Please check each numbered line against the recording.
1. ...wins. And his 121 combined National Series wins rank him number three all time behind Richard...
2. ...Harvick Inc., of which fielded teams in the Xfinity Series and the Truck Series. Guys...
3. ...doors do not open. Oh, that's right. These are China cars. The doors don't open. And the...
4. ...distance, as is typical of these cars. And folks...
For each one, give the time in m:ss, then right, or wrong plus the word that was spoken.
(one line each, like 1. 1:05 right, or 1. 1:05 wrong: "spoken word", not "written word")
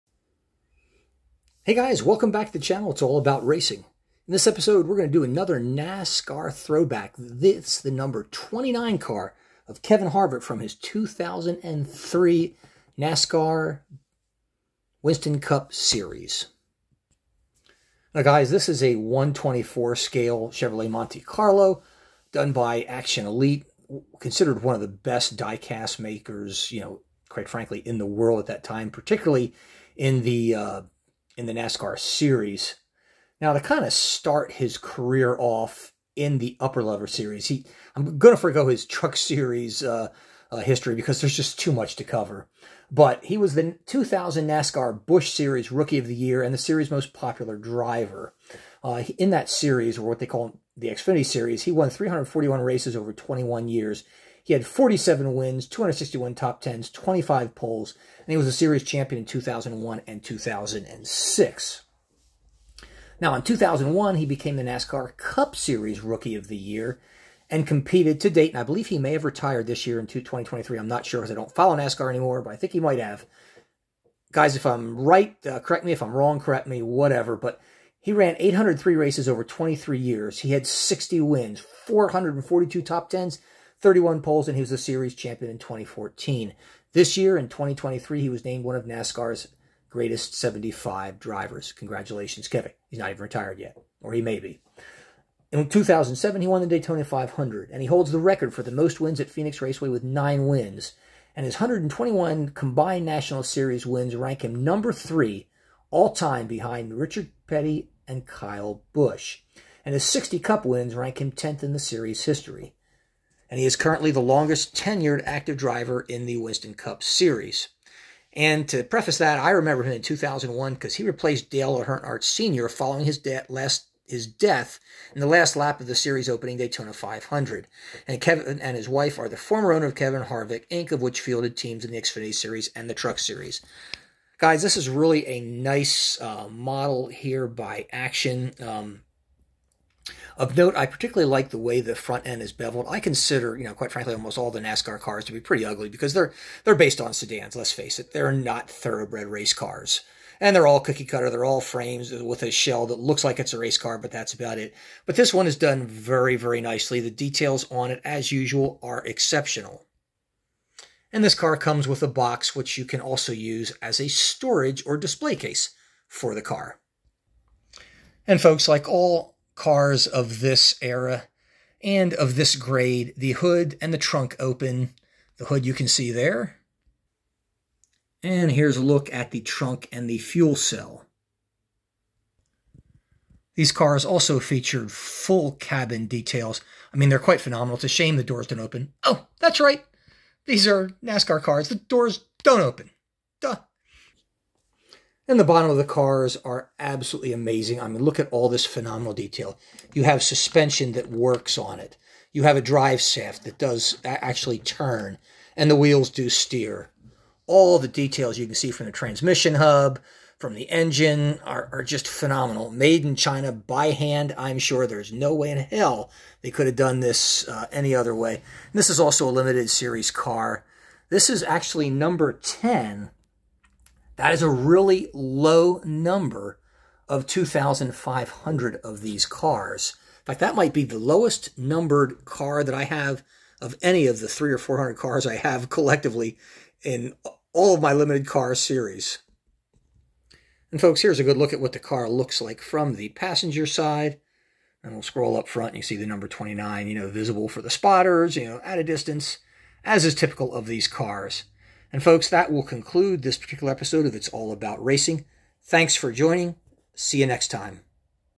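1. 1:40 right
2. 2:10 right
3. 3:08 wrong: "NASCAR", not "China"
4. 4:08 right.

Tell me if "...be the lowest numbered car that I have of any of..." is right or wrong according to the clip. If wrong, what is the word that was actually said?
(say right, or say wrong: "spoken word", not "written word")
right.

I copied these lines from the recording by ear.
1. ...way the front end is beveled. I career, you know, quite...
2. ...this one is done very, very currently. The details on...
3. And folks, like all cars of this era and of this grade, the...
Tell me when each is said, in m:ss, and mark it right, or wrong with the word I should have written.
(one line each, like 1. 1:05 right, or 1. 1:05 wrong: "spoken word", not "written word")
1. 2:21 wrong: "consider", not "career"
2. 2:35 wrong: "nicely", not "currently"
3. 2:48 right.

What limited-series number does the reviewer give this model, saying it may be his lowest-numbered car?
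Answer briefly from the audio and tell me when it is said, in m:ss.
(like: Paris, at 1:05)
10, at 3:41.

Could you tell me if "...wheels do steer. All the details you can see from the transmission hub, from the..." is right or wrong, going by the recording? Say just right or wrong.
right.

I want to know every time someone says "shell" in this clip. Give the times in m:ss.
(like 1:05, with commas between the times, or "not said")
2:32.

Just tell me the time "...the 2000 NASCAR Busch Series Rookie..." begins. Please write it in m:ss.
0:43.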